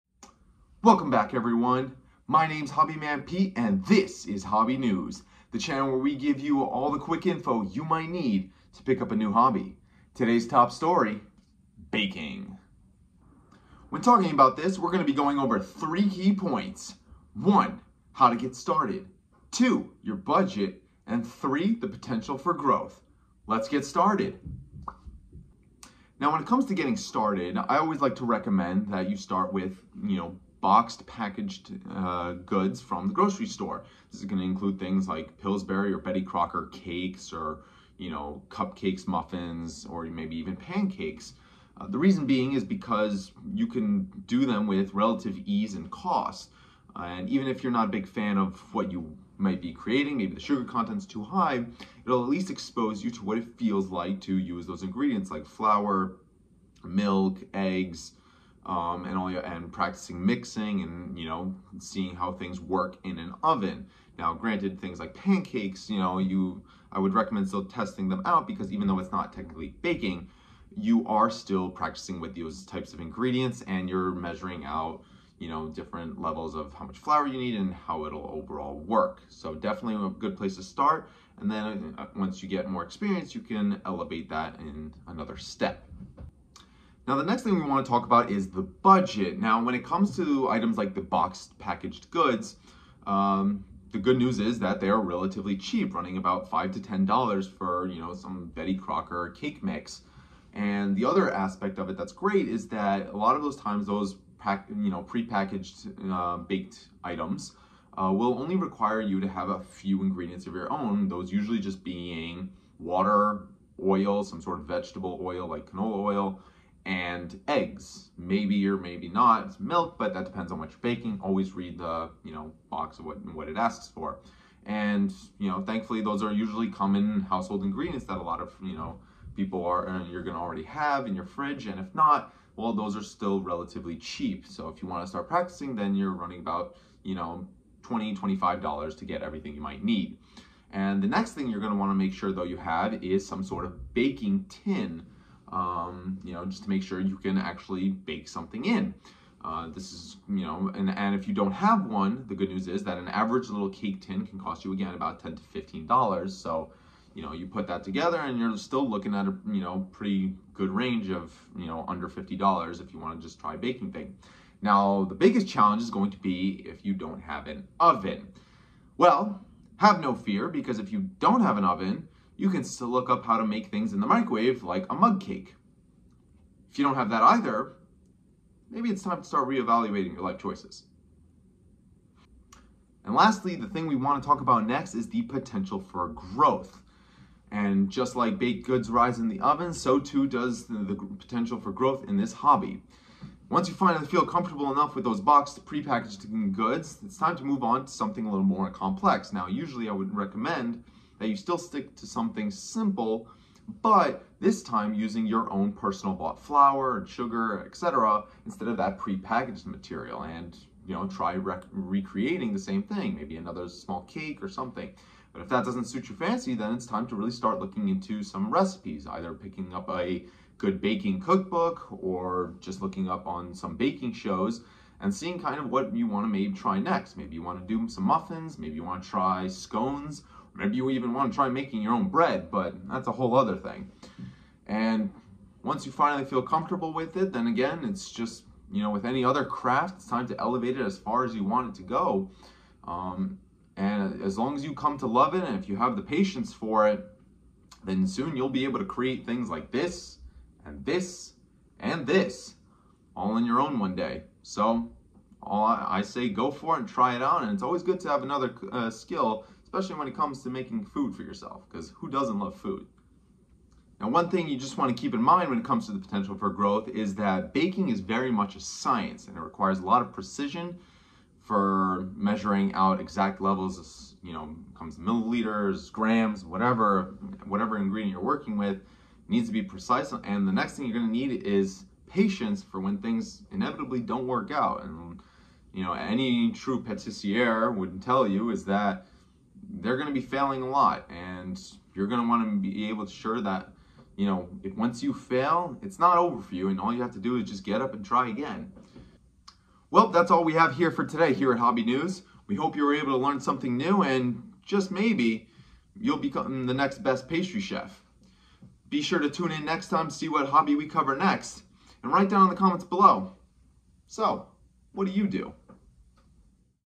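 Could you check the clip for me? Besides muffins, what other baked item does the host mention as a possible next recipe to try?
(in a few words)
scones.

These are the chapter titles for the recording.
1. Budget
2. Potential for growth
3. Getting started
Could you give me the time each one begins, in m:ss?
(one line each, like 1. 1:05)
1. 1:27
2. 3:04
3. 0:26.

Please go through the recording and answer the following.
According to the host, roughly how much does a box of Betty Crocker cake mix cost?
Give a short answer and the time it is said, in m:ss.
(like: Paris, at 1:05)
5 to 10 dollars, at 1:36.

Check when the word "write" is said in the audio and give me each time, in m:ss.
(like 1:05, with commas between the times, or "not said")
5:12.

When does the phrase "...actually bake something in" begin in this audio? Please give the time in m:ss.
2:27.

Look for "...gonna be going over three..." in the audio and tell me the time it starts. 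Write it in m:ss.
0:14.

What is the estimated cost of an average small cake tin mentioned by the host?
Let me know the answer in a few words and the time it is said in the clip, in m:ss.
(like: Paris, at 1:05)
10 to 15 dollars, at 2:35.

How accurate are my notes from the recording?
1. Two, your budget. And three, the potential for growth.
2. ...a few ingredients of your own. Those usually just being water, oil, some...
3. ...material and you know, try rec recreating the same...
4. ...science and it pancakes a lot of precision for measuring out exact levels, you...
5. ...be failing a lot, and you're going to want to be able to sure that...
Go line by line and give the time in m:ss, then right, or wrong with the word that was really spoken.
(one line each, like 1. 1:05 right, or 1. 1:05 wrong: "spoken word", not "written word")
1. 0:19 right
2. 1:49 right
3. 3:29 right
4. 4:28 wrong: "requires", not "pancakes"
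5. 4:50 right.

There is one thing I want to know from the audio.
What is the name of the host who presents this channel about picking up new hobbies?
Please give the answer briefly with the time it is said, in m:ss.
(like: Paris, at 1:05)
Hobbyman Pete, at 0:02.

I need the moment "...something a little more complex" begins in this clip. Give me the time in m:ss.
3:17.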